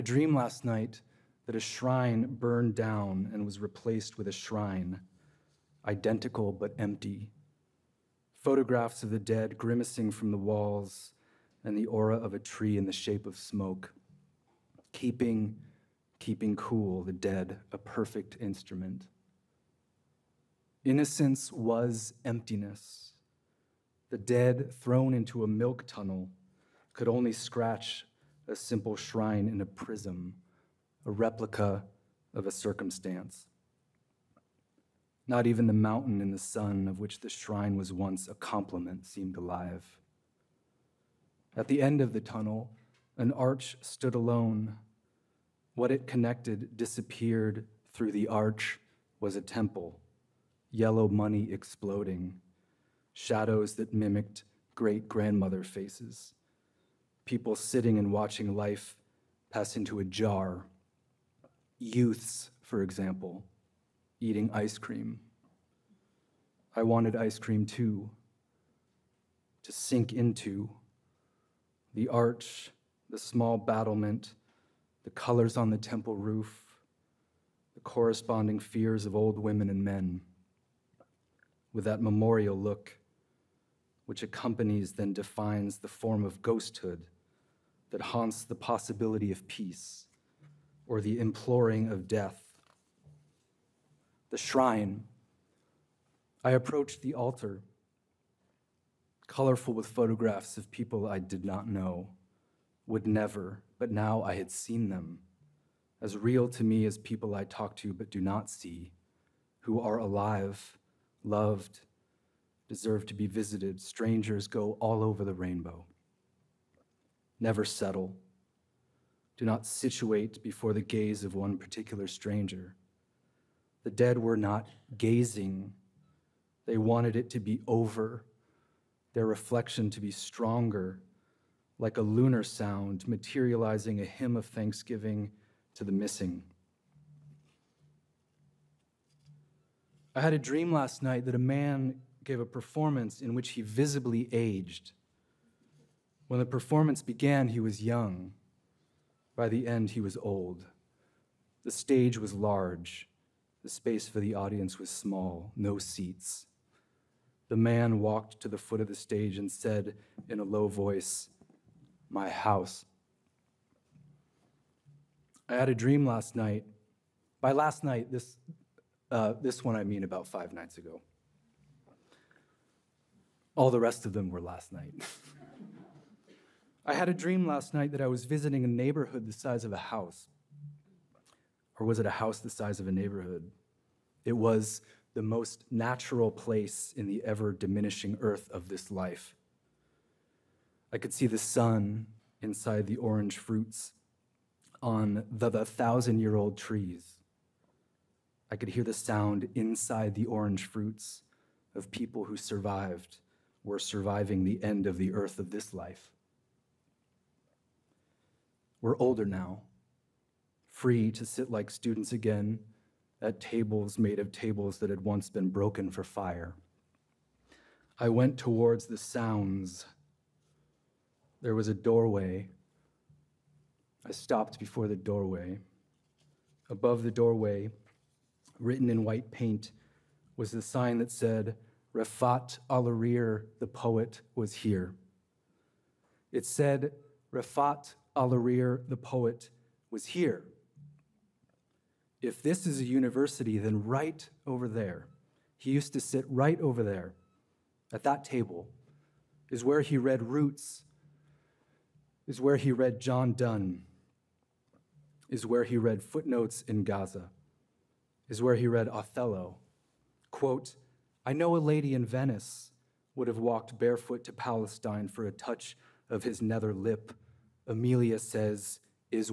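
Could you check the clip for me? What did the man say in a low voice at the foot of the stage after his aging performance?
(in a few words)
My house.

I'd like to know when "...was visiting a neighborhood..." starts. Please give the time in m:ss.
2:58.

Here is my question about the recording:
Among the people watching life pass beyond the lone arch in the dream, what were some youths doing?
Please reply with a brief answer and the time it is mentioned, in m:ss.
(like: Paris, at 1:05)
Eating ice cream, at 1:04.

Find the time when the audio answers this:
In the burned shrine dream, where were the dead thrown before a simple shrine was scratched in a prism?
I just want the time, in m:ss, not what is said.
0:25.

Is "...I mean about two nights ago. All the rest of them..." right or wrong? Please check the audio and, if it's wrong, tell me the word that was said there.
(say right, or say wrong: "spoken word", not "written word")
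wrong: "five", not "two".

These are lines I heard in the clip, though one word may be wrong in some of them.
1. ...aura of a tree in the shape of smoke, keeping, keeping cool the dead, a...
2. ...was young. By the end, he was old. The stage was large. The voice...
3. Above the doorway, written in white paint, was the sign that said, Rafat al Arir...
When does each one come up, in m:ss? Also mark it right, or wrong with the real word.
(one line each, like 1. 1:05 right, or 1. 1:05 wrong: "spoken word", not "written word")
1. 0:11 right
2. 2:27 wrong: "space", not "voice"
3. 3:46 right.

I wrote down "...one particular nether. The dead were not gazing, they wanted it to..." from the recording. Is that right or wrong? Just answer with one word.
wrong.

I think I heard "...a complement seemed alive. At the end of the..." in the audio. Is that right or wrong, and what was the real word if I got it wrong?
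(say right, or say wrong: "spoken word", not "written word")
right.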